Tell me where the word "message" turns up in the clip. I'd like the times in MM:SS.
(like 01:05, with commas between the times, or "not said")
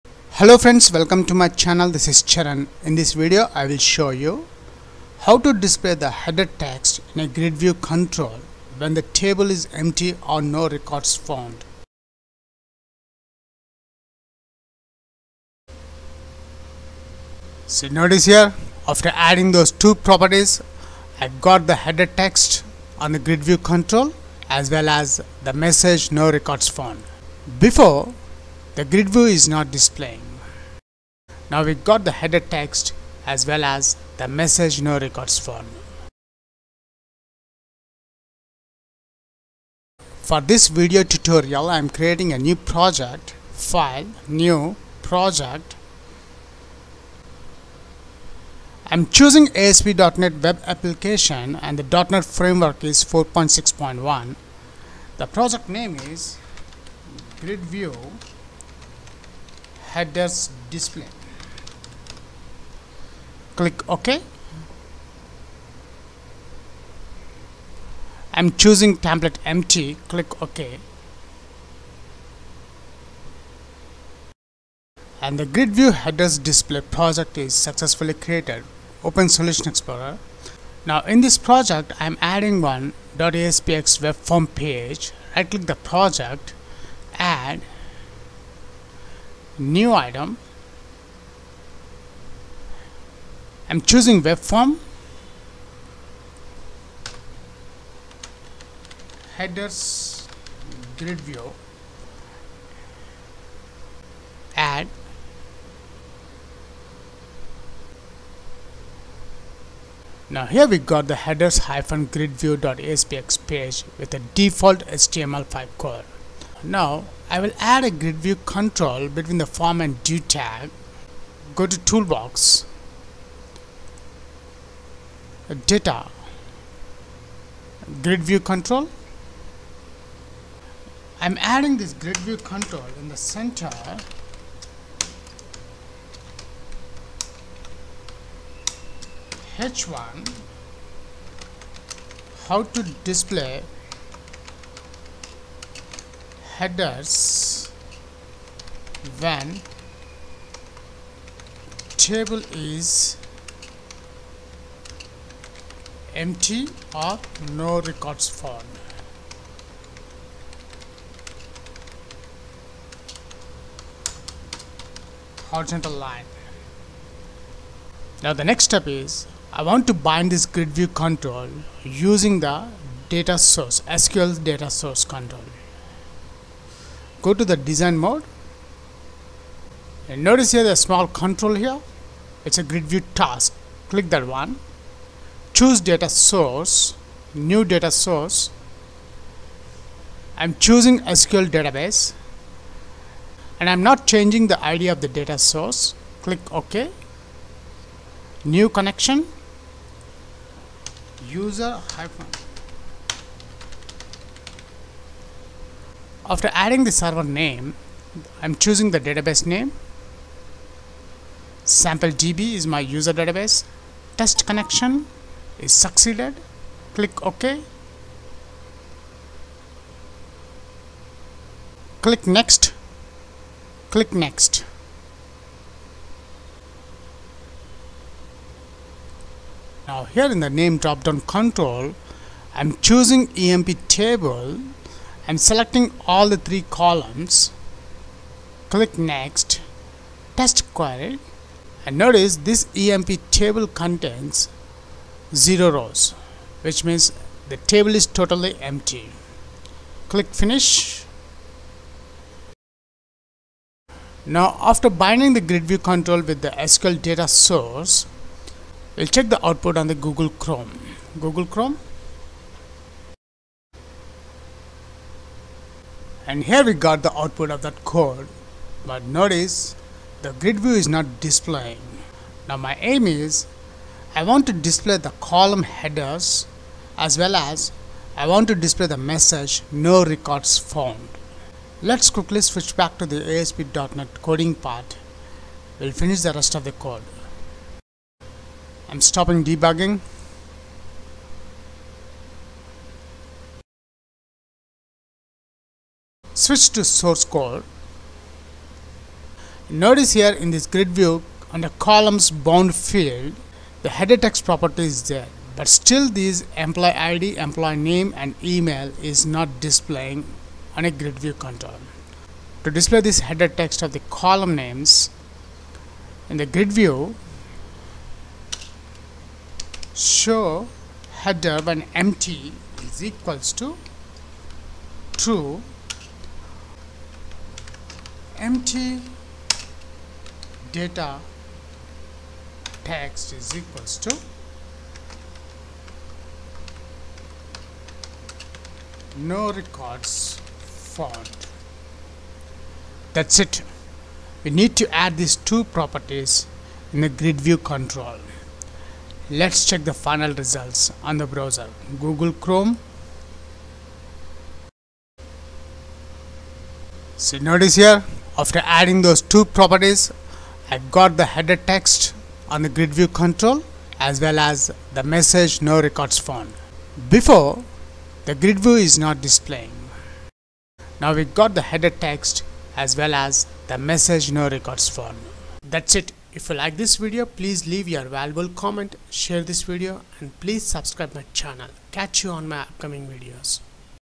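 00:25, 00:34, 04:38, 06:05, 06:13.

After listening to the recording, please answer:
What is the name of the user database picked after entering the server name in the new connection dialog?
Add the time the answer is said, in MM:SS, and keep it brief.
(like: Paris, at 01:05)
sample DB, at 03:31.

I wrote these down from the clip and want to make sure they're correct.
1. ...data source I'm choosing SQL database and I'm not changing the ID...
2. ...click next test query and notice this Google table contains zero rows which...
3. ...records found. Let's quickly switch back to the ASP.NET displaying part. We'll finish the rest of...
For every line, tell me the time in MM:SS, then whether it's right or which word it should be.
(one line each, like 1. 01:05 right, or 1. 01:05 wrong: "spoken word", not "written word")
1. 03:07 right
2. 03:58 wrong: "EMP", not "Google"
3. 04:40 wrong: "coding", not "displaying".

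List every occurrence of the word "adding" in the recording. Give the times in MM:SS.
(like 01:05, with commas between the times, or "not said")
00:19, 01:22, 02:11, 03:26, 05:58.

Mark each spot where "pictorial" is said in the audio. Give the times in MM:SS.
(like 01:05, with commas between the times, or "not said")
not said.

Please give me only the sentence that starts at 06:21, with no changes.
Catch you on my upcoming videos.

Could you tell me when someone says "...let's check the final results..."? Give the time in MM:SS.
05:49.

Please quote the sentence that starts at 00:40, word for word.
For this video tutorial, I am creating a new project, file, new, project.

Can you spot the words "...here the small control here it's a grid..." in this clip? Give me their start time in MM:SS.
03:00.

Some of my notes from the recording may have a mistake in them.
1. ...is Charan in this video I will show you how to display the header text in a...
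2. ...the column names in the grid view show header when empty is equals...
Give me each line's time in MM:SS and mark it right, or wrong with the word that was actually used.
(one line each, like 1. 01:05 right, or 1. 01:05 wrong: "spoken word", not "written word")
1. 00:02 right
2. 05:13 right.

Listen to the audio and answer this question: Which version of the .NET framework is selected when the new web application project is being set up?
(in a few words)
4.6.1.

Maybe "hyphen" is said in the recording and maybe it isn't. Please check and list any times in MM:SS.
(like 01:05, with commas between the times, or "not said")
01:51, 03:21.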